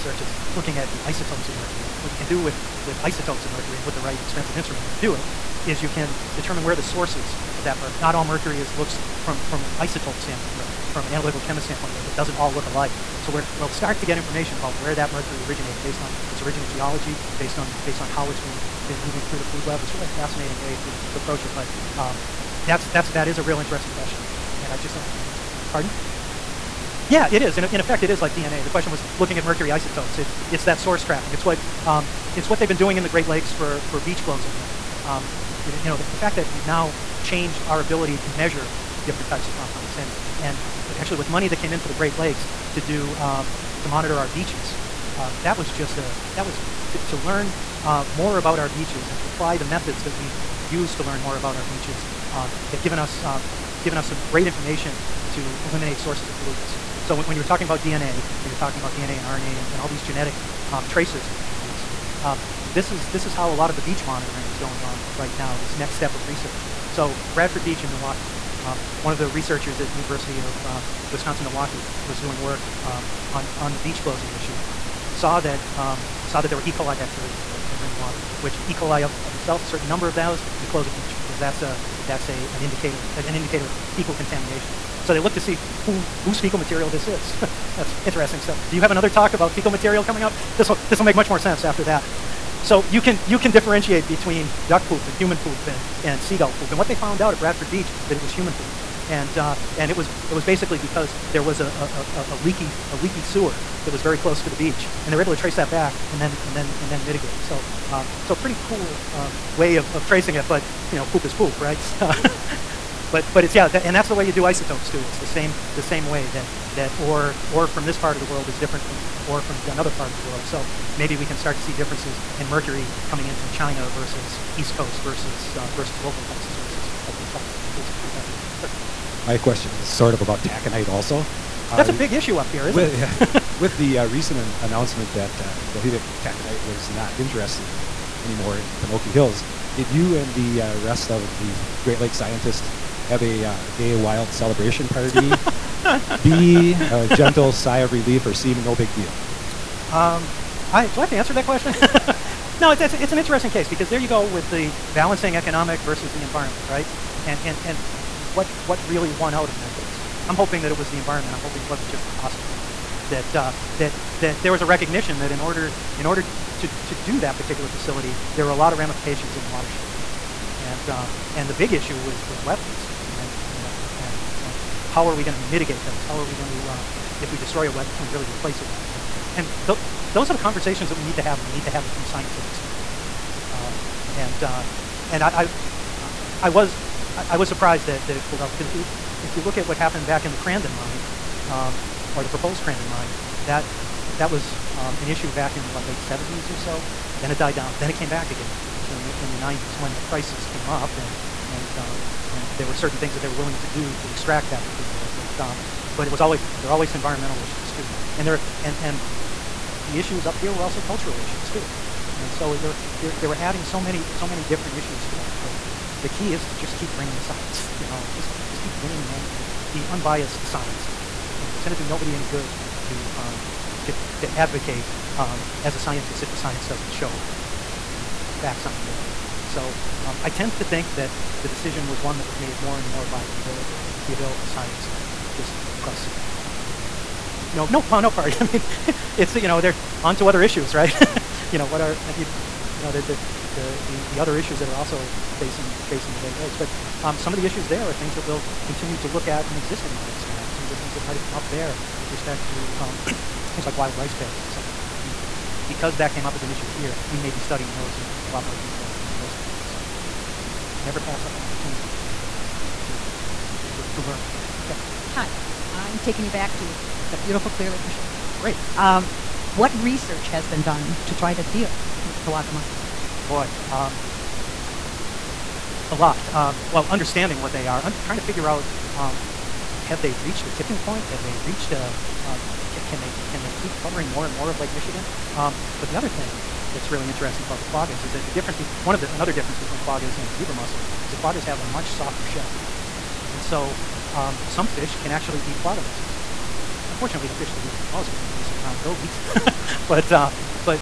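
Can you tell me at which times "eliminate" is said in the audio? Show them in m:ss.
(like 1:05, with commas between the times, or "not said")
0:55.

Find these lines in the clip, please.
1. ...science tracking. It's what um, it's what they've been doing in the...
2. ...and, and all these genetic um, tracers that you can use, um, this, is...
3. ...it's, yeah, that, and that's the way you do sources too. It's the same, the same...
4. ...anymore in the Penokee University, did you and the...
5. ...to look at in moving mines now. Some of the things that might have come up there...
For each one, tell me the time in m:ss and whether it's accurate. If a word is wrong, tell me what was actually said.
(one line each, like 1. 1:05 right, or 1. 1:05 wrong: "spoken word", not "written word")
1. 0:30 wrong: "source", not "science"
2. 0:59 right
3. 1:53 wrong: "isotopes", not "sources"
4. 2:18 wrong: "Hills", not "University"
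5. 4:08 wrong: "existing", not "moving".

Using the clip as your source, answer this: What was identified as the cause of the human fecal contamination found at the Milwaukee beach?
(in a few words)
A leaky sewer.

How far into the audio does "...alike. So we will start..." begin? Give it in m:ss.
0:12.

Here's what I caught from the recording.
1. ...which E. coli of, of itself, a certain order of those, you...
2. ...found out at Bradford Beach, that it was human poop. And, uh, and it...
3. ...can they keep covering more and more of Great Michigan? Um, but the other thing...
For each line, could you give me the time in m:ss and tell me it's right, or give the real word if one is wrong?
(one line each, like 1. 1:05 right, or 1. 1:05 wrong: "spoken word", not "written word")
1. 1:18 wrong: "number", not "order"
2. 1:36 right
3. 4:43 wrong: "Lake", not "Great".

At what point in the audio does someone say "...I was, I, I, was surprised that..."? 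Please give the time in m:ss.
3:06.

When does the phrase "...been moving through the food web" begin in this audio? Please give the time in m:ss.
0:18.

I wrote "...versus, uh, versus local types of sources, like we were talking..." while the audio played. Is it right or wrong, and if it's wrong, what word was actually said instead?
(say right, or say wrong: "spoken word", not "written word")
right.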